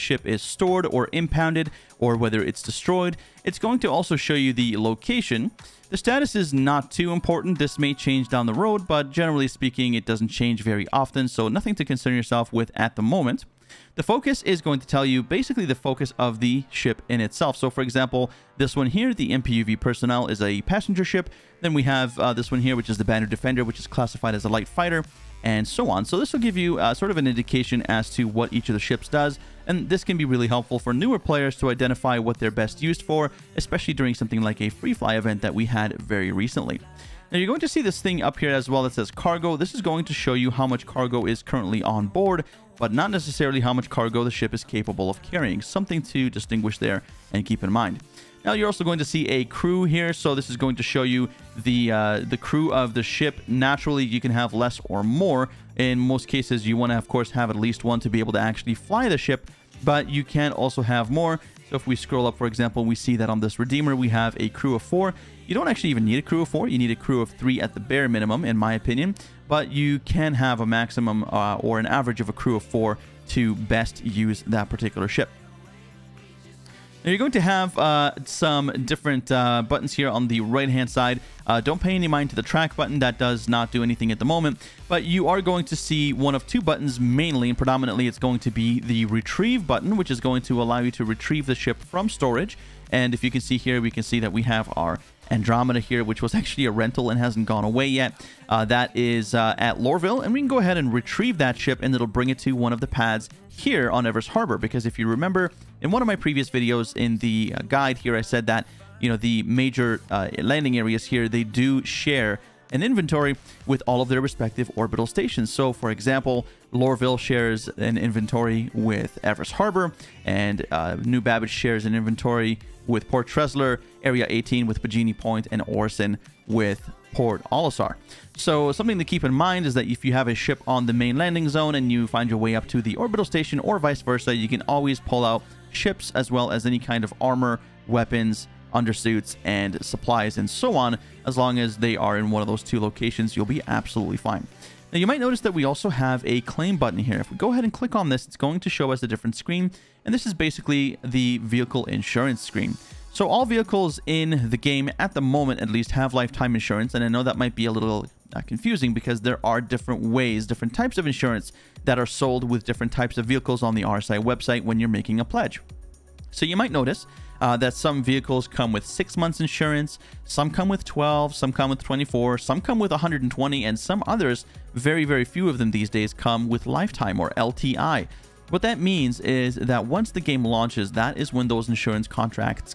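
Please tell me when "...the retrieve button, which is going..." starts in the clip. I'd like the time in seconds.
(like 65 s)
88 s.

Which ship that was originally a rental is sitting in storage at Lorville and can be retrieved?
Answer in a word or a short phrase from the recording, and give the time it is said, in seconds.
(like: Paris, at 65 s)
Andromeda, at 95 s.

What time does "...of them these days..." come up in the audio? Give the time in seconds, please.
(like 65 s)
175 s.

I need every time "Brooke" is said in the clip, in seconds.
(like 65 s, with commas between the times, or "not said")
not said.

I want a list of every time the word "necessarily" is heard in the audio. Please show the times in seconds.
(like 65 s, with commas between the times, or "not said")
43 s.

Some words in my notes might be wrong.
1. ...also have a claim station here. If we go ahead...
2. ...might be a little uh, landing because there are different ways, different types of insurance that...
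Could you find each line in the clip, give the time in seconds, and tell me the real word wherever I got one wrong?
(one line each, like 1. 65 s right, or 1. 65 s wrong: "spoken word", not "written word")
1. 145 s wrong: "button", not "station"
2. 157 s wrong: "confusing", not "landing".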